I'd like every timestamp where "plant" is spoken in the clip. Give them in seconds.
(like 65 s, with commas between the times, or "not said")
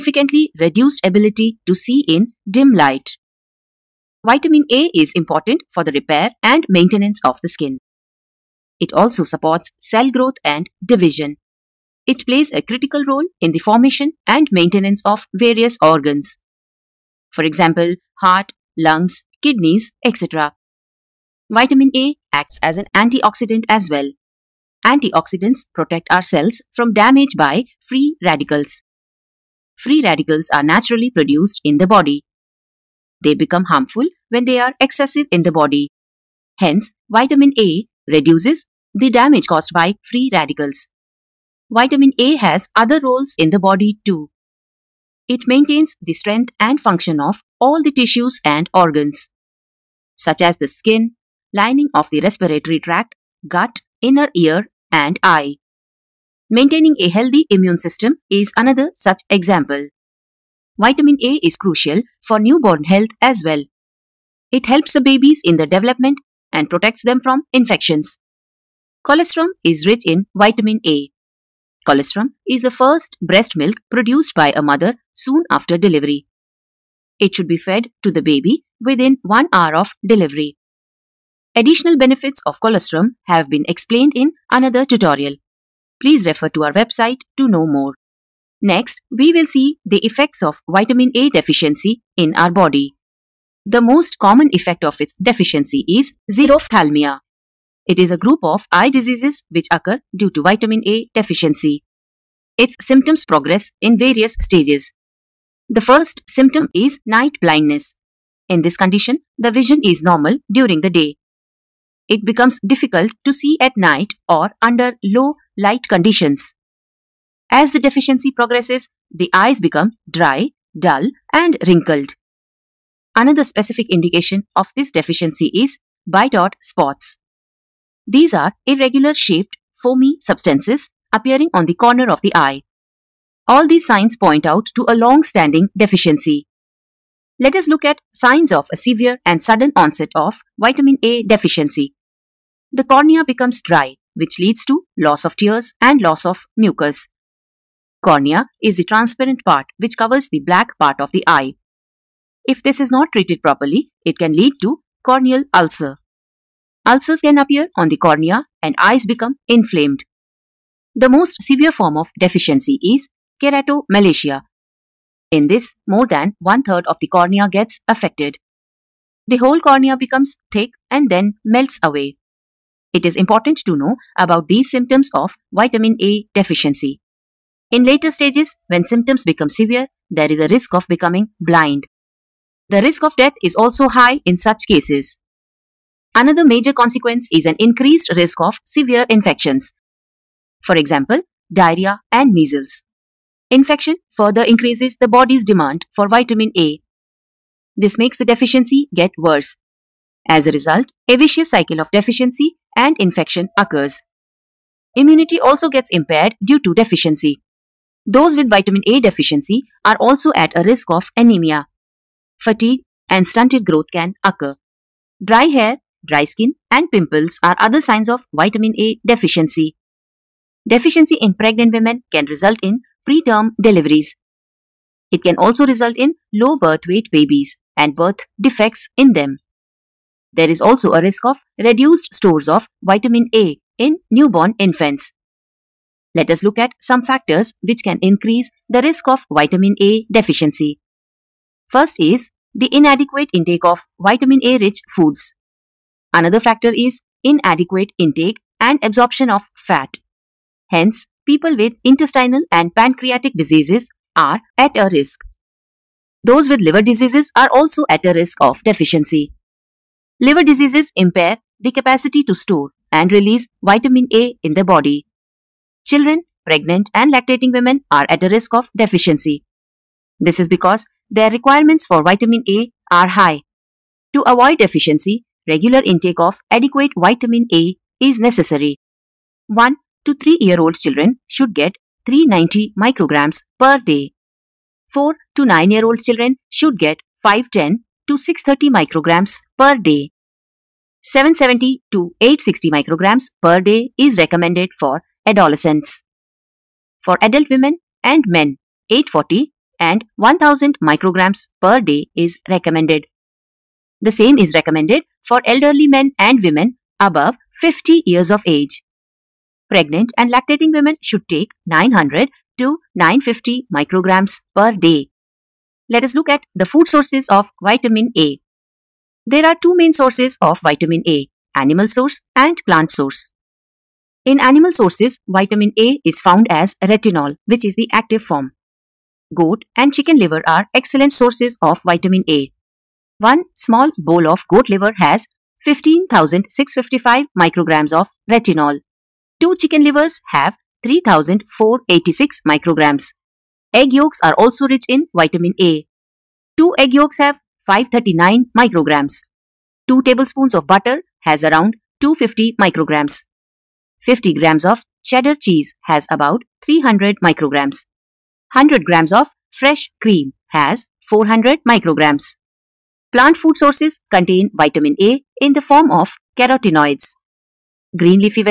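322 s, 363 s.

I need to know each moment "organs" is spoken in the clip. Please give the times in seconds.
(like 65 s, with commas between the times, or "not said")
15 s, 48 s.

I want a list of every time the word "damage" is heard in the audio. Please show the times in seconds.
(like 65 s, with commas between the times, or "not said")
26 s, 39 s.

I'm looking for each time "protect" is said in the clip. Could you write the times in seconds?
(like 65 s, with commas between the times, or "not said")
25 s, 66 s.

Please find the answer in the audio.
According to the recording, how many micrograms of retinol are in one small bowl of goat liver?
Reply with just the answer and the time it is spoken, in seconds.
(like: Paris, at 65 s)
15,655 micrograms, at 335 s.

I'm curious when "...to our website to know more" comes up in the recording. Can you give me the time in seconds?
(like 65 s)
86 s.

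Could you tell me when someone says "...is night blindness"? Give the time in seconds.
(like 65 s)
106 s.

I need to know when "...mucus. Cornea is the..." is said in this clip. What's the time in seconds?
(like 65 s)
146 s.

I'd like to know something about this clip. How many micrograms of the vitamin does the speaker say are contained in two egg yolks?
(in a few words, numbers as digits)
539 micrograms.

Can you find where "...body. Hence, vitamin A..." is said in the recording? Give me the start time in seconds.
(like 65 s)
35 s.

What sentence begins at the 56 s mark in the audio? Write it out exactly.
Maintaining a healthy immune system is another such example.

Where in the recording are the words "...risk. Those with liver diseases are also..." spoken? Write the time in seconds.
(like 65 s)
254 s.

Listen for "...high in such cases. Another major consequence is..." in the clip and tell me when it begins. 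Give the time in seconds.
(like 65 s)
183 s.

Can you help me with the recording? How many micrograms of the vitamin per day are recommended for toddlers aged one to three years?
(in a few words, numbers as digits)
390 micrograms.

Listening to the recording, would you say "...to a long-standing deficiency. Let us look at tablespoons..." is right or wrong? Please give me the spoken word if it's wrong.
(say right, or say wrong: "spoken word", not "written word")
wrong: "signs", not "tablespoons".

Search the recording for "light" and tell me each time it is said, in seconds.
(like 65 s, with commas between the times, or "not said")
2 s, 115 s.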